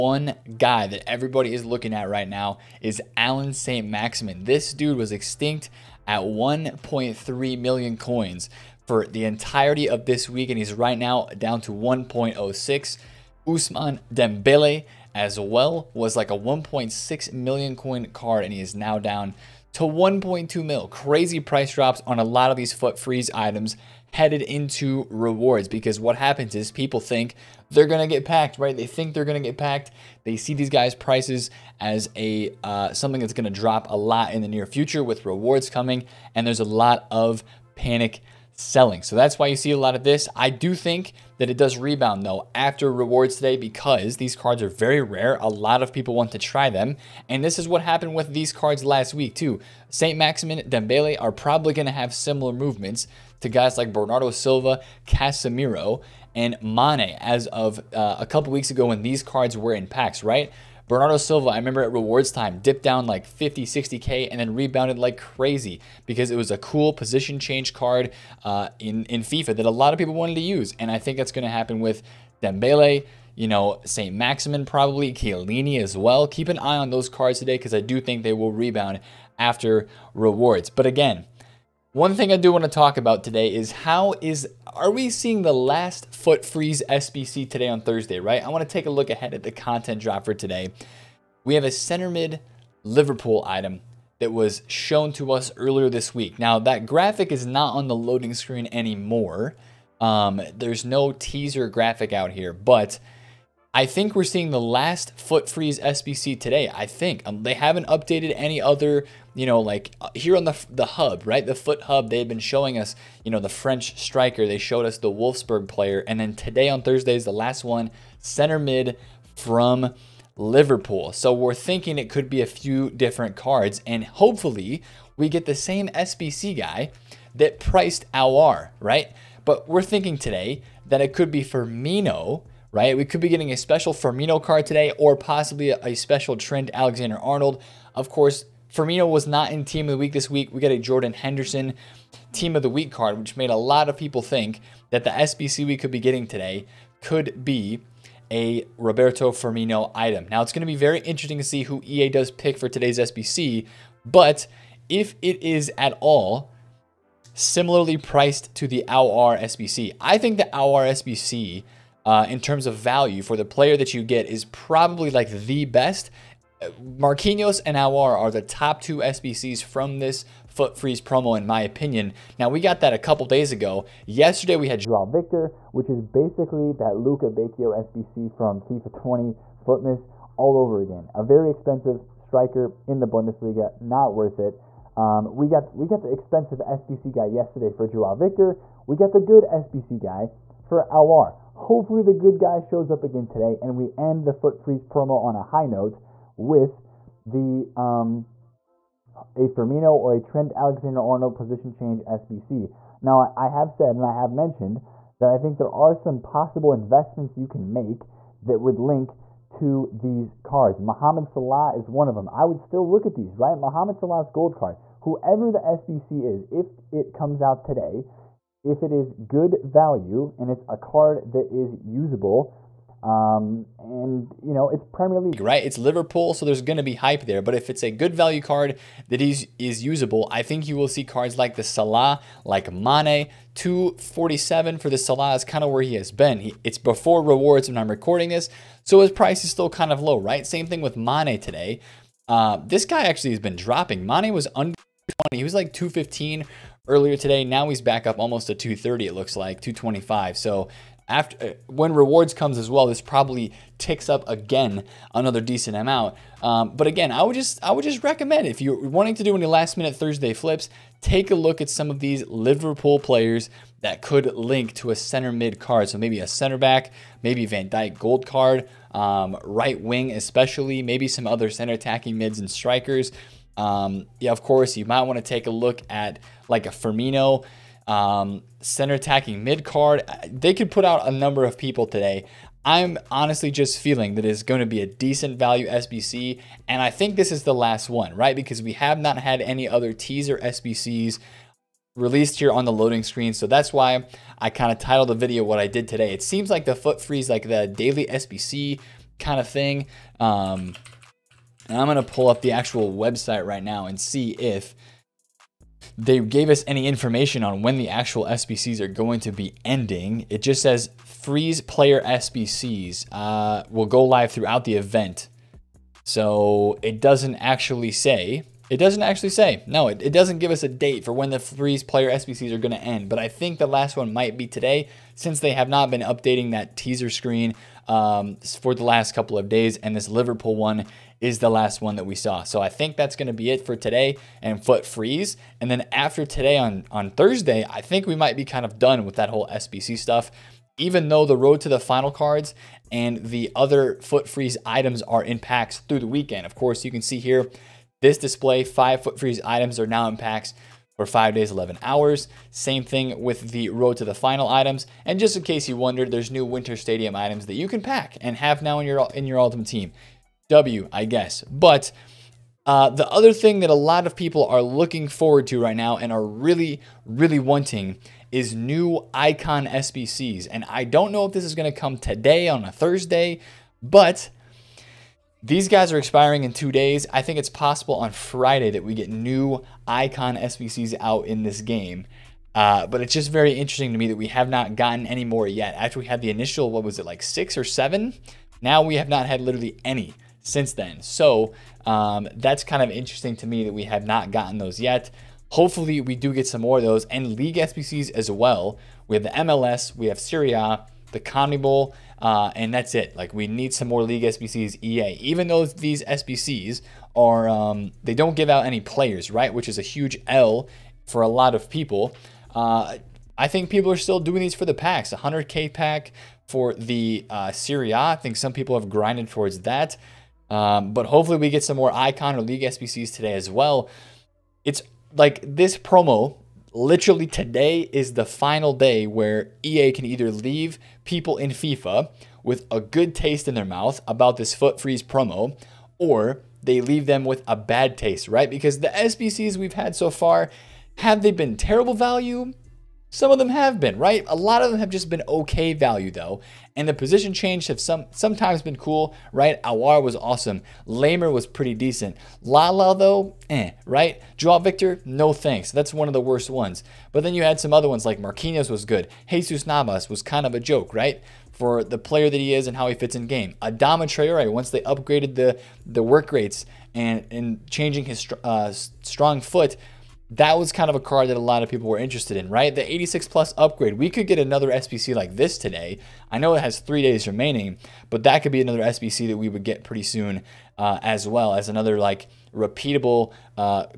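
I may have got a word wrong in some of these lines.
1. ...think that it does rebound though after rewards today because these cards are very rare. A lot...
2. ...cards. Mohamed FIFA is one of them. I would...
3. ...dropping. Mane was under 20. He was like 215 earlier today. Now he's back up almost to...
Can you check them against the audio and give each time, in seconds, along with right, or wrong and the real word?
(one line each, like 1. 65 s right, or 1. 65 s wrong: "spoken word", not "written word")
1. 40 s right
2. 210 s wrong: "Salah", not "FIFA"
3. 243 s right.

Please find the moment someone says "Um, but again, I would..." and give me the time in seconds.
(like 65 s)
256 s.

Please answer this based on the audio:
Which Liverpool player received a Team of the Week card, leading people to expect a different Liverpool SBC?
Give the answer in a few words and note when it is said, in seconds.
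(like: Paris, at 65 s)
Jordan Henderson, at 140 s.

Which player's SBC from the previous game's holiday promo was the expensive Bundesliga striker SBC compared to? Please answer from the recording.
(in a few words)
Luca Bacchio.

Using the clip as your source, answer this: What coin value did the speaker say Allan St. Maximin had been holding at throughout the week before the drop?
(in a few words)
1.3 million coins.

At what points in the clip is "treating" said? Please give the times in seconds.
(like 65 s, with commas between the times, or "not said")
not said.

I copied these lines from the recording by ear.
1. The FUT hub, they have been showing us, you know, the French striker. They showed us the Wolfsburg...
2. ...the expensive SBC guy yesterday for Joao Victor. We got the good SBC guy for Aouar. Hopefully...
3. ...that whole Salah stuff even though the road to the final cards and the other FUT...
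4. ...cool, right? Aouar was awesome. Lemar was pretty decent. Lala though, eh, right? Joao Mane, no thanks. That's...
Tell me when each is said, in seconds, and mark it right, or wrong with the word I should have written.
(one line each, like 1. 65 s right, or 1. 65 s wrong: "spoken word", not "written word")
1. 111 s right
2. 186 s right
3. 339 s wrong: "SBC", not "Salah"
4. 448 s wrong: "Victor", not "Mane".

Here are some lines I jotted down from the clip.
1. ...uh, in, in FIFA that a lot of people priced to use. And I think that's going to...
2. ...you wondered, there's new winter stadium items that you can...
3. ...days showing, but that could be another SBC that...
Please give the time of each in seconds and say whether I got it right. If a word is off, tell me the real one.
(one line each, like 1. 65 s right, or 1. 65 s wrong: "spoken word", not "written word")
1. 68 s wrong: "wanted", not "priced"
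2. 355 s right
3. 477 s wrong: "remaining", not "showing".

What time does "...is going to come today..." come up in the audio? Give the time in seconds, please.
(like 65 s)
371 s.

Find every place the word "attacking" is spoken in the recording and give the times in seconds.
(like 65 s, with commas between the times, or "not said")
271 s, 278 s.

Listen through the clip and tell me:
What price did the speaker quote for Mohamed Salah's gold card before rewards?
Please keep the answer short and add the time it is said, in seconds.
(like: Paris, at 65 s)
247, at 233 s.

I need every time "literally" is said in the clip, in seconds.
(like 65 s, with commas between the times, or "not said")
389 s, 426 s.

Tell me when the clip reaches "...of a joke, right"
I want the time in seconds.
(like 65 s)
460 s.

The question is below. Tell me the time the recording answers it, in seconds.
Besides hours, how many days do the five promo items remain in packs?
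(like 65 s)
351 s.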